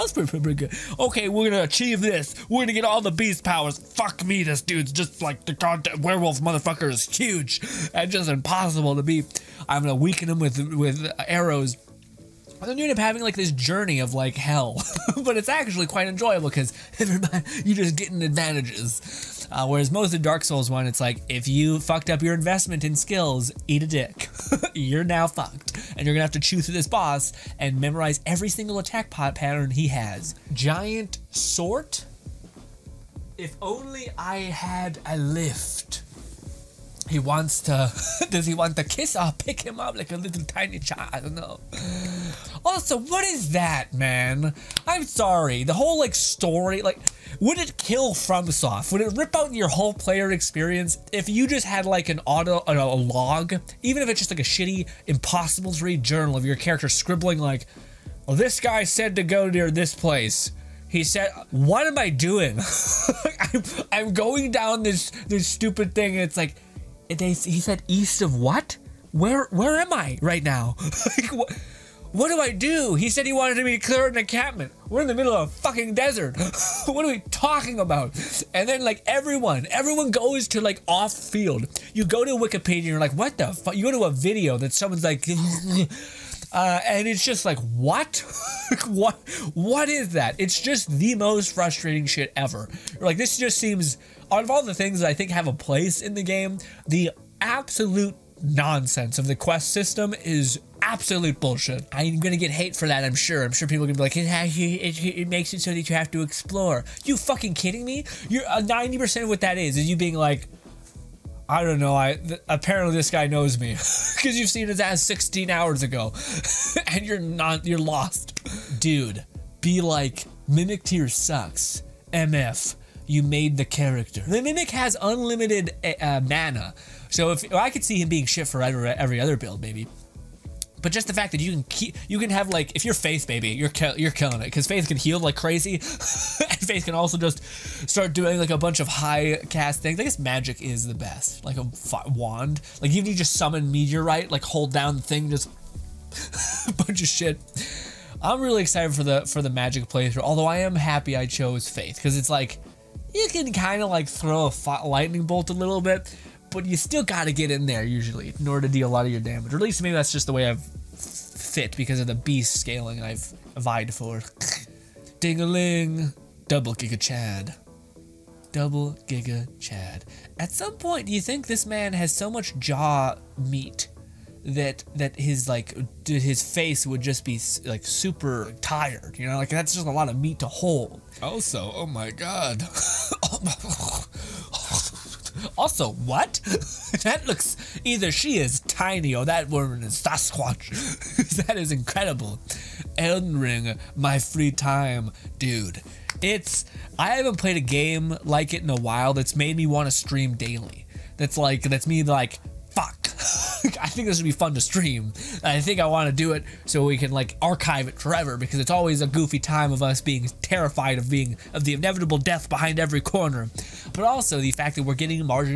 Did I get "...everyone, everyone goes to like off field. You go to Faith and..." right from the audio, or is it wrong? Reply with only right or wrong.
wrong.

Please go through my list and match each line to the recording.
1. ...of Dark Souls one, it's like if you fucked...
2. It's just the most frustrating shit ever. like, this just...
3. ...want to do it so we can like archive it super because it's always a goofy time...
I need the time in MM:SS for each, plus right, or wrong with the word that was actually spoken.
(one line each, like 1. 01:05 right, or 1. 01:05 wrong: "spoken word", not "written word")
1. 00:20 right
2. 01:30 right
3. 03:25 wrong: "forever", not "super".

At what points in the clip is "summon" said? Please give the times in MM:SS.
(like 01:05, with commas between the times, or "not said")
02:23.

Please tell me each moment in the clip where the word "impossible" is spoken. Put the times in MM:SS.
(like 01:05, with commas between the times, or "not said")
00:08, 00:55.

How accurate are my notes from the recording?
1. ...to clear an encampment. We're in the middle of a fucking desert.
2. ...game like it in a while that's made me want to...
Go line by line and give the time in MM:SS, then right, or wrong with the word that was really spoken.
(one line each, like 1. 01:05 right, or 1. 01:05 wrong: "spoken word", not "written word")
1. 01:13 right
2. 03:17 right.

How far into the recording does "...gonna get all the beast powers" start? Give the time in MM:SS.
00:02.